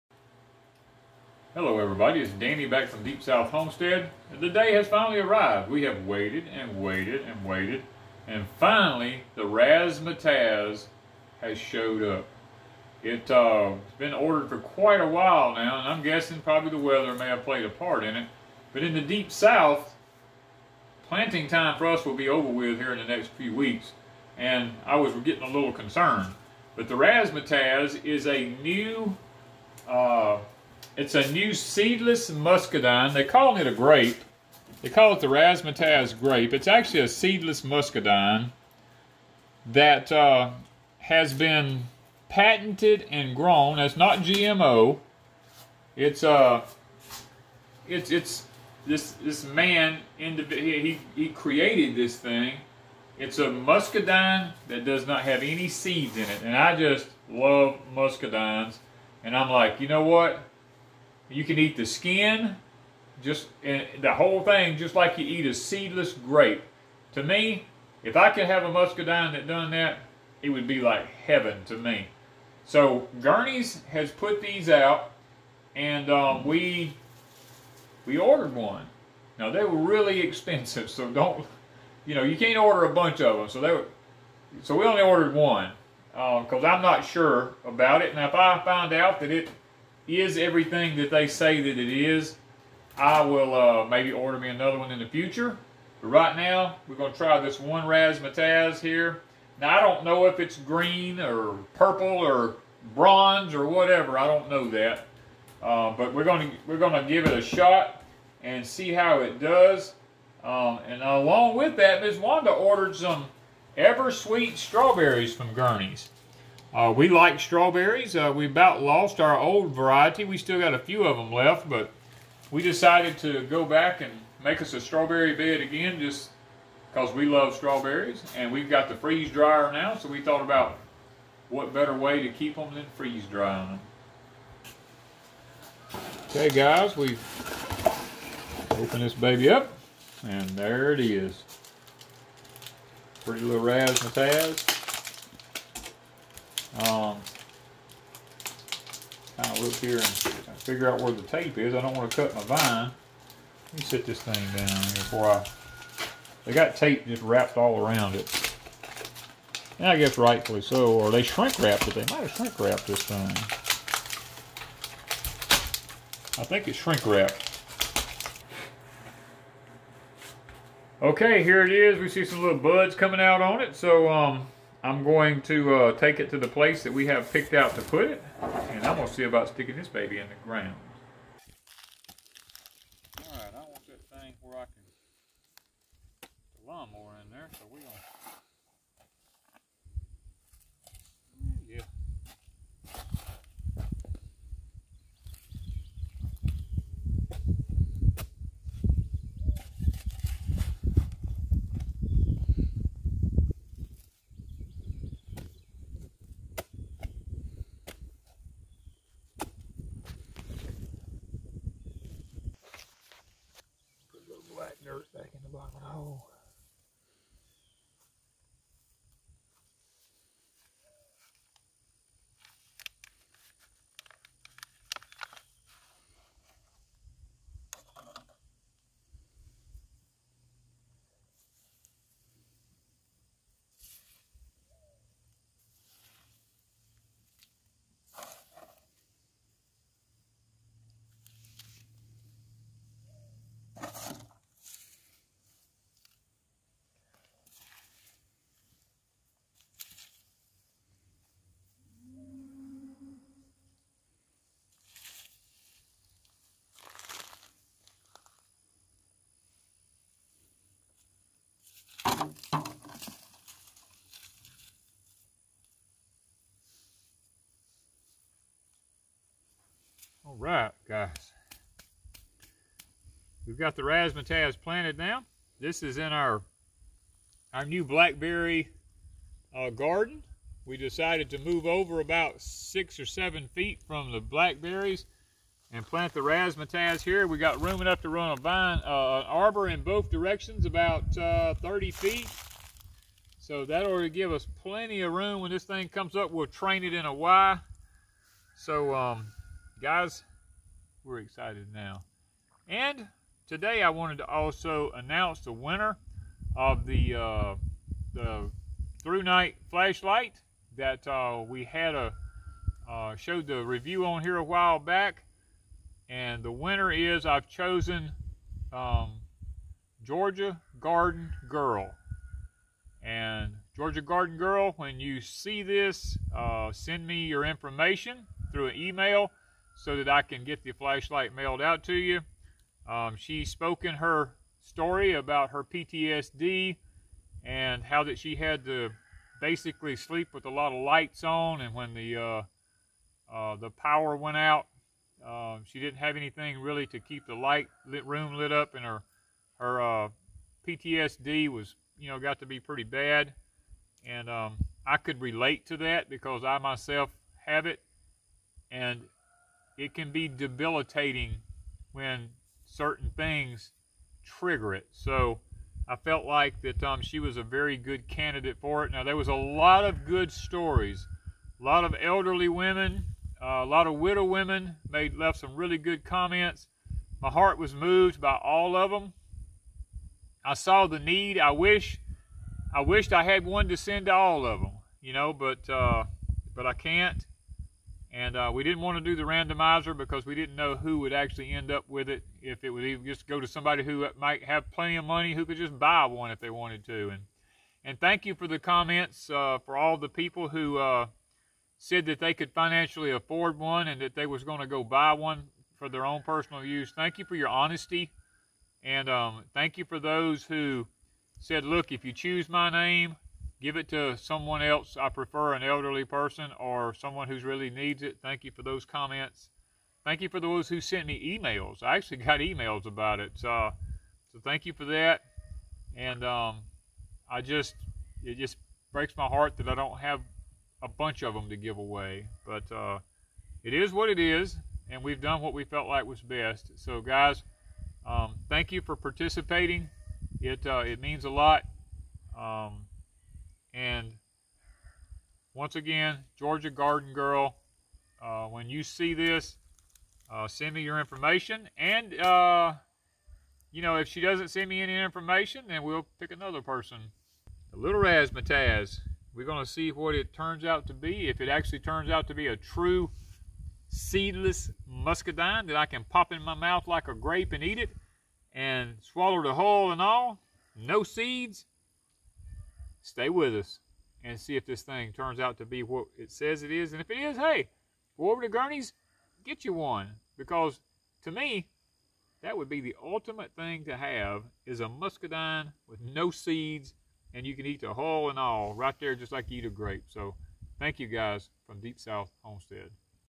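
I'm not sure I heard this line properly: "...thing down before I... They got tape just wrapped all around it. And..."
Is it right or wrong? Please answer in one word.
right.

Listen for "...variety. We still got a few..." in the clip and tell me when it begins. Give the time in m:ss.
1:59.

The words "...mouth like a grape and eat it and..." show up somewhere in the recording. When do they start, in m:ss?
7:46.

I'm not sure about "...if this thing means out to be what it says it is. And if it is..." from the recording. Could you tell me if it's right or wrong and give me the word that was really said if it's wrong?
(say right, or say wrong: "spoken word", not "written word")
wrong: "turns", not "means".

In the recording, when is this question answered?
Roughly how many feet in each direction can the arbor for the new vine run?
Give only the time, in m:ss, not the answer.
4:51.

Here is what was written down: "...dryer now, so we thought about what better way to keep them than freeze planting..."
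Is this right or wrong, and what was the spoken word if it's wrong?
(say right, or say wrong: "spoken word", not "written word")
wrong: "drying", not "planting".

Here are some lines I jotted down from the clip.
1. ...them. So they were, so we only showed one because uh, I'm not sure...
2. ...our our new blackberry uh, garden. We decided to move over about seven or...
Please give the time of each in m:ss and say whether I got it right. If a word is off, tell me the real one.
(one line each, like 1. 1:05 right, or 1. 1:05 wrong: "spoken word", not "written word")
1. 1:23 wrong: "ordered", not "showed"
2. 4:36 wrong: "six", not "seven".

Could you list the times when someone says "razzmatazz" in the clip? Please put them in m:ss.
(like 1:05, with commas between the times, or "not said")
0:09, 0:26, 0:35, 1:37, 2:23, 4:33, 4:46, 7:38.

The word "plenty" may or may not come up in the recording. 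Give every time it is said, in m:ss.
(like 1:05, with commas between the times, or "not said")
4:54, 6:34.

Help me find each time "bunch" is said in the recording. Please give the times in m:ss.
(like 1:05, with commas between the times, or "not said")
1:22, 7:10.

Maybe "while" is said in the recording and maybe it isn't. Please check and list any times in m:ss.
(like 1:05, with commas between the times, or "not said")
0:15, 5:14.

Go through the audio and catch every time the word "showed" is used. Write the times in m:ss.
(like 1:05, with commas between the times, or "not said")
0:11, 5:13.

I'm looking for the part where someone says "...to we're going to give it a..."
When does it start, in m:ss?
1:46.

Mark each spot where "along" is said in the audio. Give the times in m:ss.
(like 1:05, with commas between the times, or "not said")
1:51.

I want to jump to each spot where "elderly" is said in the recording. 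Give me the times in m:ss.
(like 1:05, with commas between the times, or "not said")
6:12, 6:55.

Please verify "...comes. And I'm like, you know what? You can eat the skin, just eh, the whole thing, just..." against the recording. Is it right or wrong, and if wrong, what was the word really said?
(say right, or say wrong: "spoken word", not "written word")
wrong: "muscadines", not "comes".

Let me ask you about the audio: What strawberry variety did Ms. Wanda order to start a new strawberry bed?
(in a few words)
Eversweet.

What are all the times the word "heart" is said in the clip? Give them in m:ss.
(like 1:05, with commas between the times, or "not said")
6:17, 7:09.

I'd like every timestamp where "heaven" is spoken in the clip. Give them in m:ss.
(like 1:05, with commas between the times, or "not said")
1:11.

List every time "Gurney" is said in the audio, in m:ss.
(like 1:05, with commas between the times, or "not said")
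1:13, 1:55, 7:58.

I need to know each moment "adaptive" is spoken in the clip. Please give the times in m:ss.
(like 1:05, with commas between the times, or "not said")
not said.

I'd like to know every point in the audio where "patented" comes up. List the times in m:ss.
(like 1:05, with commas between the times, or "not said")
0:42.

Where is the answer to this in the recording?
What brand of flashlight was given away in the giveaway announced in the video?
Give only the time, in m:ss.
5:09.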